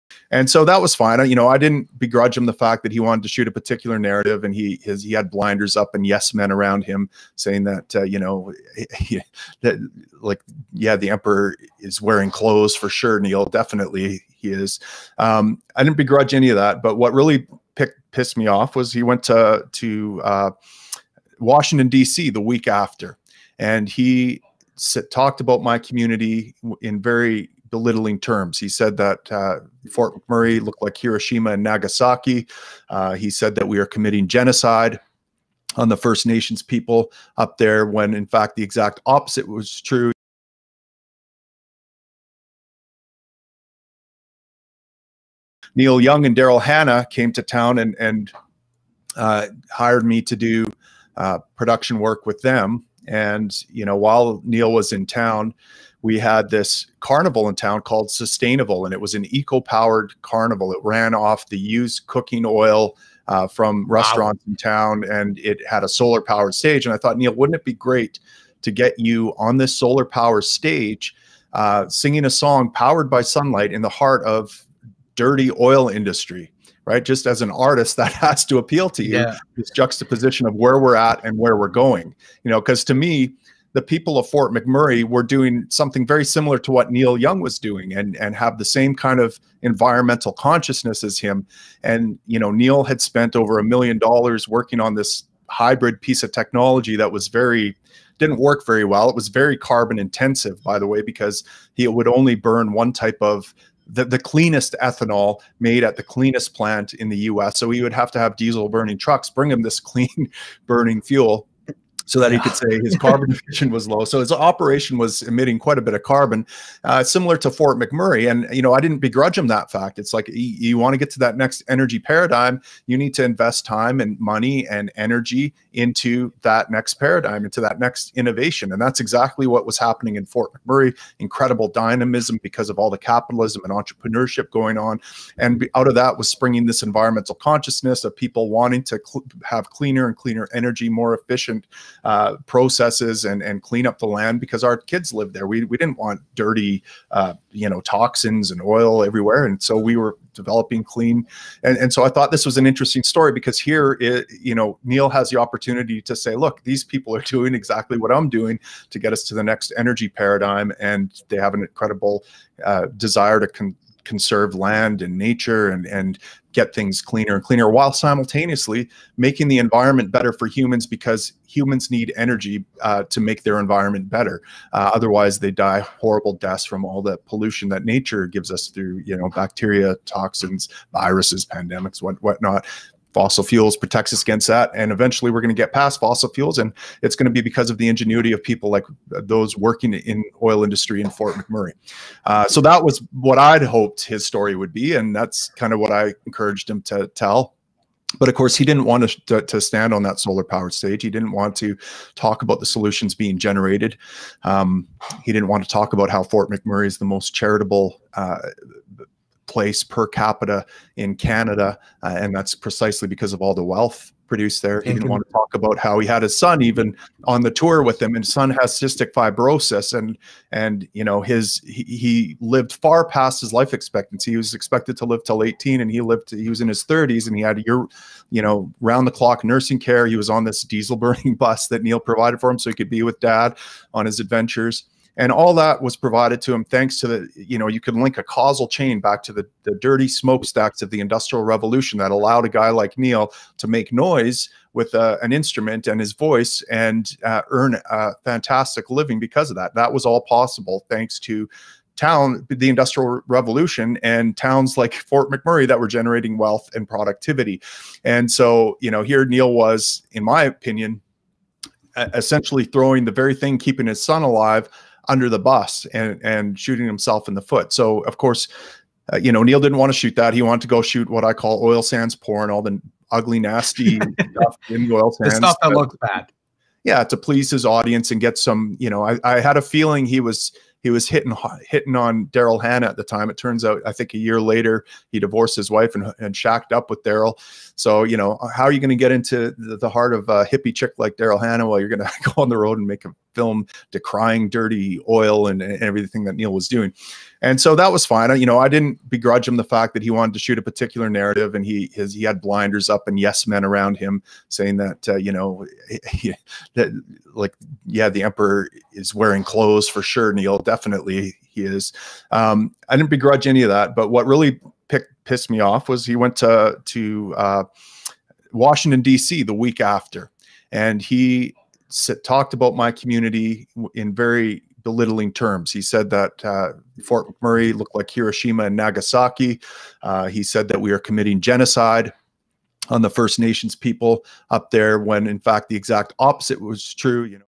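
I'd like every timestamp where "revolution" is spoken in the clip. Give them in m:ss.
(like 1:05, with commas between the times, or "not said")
4:01, 4:13.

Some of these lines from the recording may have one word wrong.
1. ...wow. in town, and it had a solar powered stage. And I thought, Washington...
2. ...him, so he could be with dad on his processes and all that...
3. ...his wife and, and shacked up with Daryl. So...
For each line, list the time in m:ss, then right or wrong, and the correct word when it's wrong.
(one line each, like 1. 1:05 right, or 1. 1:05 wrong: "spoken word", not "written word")
1. 1:04 wrong: "Neil", not "Washington"
2. 3:52 wrong: "adventures", not "processes"
3. 4:45 right.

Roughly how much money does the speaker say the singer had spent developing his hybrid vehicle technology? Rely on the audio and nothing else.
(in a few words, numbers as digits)
Over $1 million.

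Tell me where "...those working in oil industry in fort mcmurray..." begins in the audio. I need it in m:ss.
3:09.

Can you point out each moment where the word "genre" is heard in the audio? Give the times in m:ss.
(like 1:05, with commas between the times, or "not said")
not said.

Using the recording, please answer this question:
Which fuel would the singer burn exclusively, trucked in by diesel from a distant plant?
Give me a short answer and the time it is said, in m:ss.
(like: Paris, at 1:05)
Ethanol, at 1:44.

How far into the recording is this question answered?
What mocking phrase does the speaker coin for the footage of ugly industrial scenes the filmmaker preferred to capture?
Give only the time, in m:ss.
4:31.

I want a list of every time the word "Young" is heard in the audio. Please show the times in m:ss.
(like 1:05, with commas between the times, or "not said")
0:46, 1:27.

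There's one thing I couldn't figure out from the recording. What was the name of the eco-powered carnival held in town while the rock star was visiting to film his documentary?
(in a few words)
Sustainival.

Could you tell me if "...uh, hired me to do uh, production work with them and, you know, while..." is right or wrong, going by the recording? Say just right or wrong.
right.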